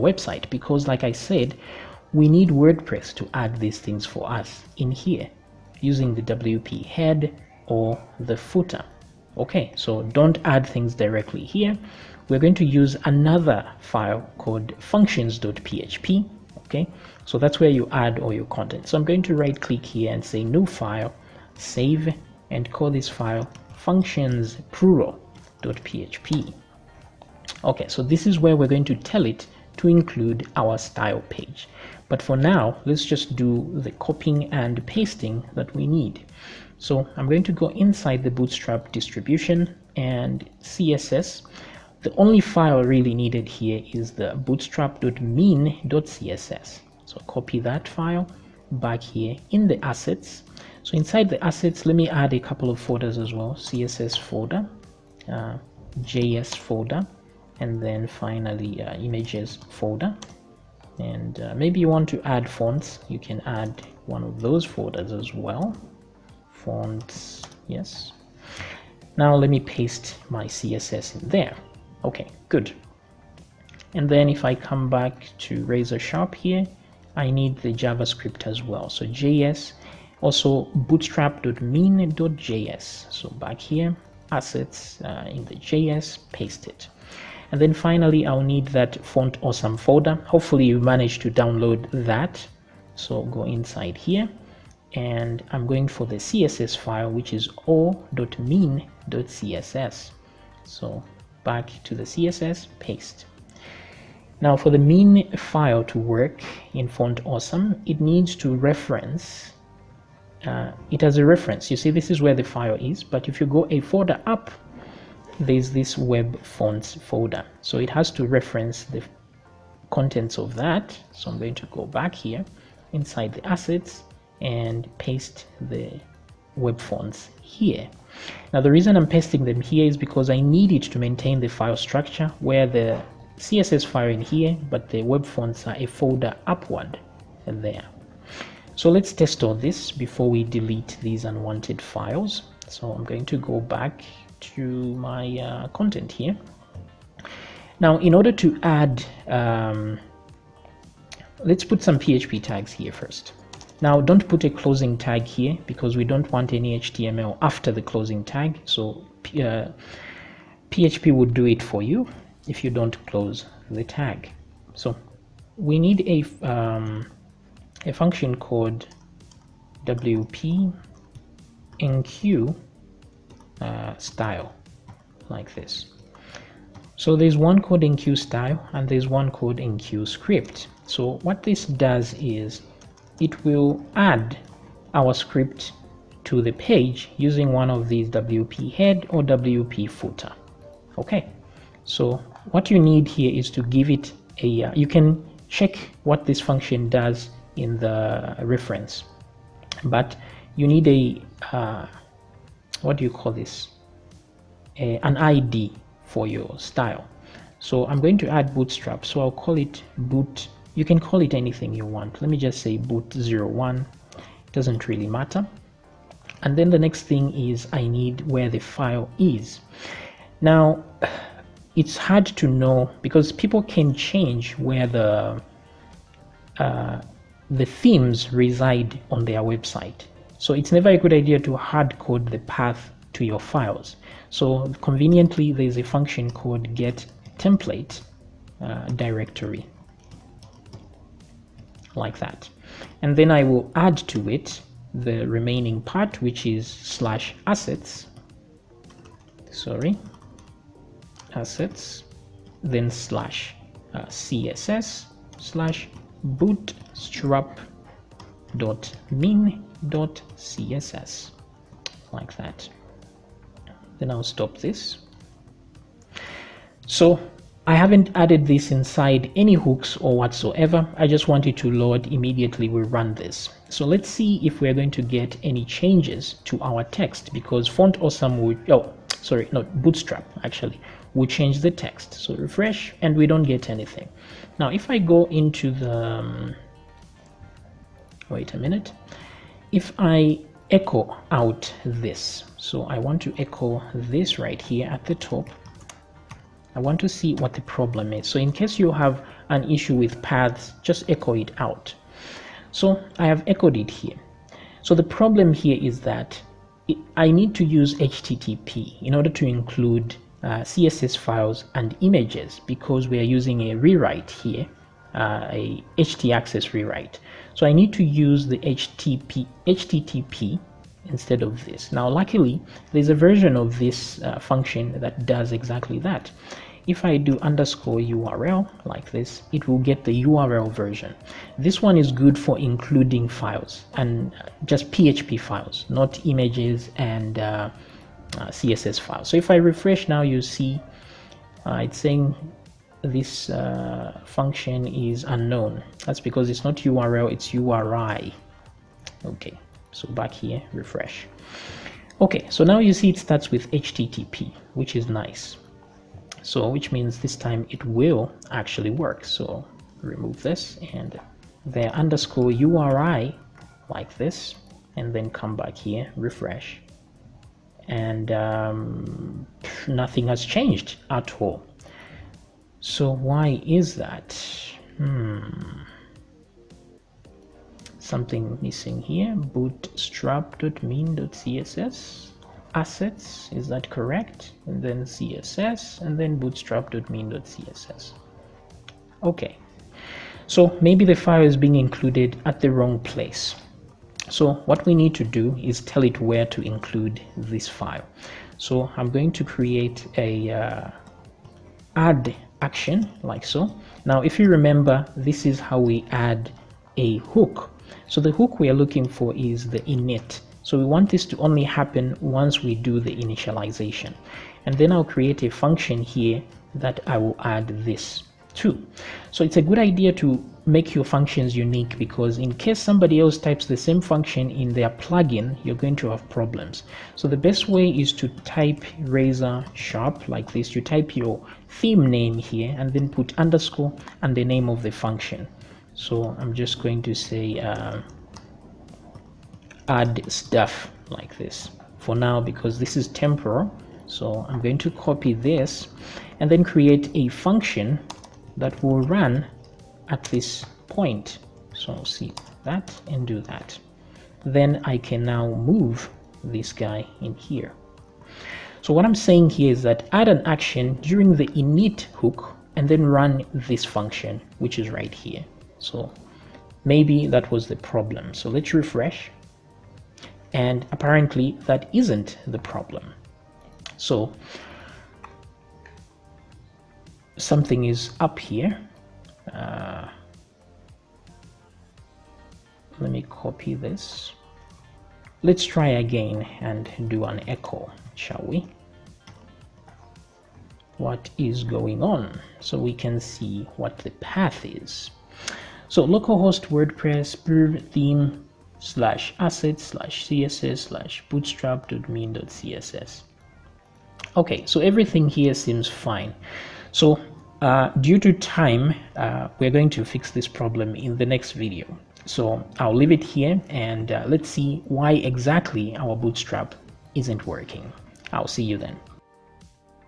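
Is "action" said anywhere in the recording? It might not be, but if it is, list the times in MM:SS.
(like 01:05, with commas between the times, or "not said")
06:42, 07:40.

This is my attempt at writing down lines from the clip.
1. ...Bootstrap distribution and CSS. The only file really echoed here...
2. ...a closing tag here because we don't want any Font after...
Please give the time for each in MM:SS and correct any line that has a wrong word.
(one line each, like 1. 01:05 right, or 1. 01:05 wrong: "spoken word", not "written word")
1. 00:38 wrong: "needed", not "echoed"
2. 02:34 wrong: "HTML", not "Font".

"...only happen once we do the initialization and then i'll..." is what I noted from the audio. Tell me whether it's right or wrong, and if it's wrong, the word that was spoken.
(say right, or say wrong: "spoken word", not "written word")
right.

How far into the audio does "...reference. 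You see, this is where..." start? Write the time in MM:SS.
01:51.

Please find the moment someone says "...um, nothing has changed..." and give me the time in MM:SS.
06:08.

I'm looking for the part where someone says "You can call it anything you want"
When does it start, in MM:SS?
03:30.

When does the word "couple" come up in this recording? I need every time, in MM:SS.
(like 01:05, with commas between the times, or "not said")
00:52.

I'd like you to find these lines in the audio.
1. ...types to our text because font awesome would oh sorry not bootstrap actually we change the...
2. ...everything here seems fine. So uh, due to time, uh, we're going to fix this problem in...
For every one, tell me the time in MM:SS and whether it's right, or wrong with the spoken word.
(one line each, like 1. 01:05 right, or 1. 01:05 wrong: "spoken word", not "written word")
1. 04:35 wrong: "changes", not "types"
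2. 08:24 right.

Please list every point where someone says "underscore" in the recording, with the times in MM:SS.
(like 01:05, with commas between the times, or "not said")
05:27, 06:01, 07:13.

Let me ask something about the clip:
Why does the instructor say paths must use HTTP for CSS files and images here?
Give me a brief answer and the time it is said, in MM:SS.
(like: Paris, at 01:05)
htaccess rewrite, at 05:15.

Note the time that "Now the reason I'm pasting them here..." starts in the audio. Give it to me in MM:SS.
02:08.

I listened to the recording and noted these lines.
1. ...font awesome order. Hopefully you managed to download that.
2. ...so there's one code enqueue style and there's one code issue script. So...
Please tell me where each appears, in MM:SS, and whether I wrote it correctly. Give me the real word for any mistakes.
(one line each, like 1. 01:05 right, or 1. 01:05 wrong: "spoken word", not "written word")
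1. 01:29 wrong: "folder", not "order"
2. 02:56 wrong: "enqueue", not "issue".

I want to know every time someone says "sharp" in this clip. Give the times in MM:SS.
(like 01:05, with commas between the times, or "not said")
01:15, 07:09.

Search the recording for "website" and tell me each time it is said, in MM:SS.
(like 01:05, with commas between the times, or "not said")
00:00, 03:49.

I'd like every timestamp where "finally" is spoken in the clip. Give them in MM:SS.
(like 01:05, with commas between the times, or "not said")
00:58, 01:27.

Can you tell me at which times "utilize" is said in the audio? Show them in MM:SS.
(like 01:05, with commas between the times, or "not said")
not said.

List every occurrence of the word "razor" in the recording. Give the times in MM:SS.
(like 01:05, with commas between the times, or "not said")
01:15, 07:09.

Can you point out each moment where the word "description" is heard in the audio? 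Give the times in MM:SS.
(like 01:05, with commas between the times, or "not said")
not said.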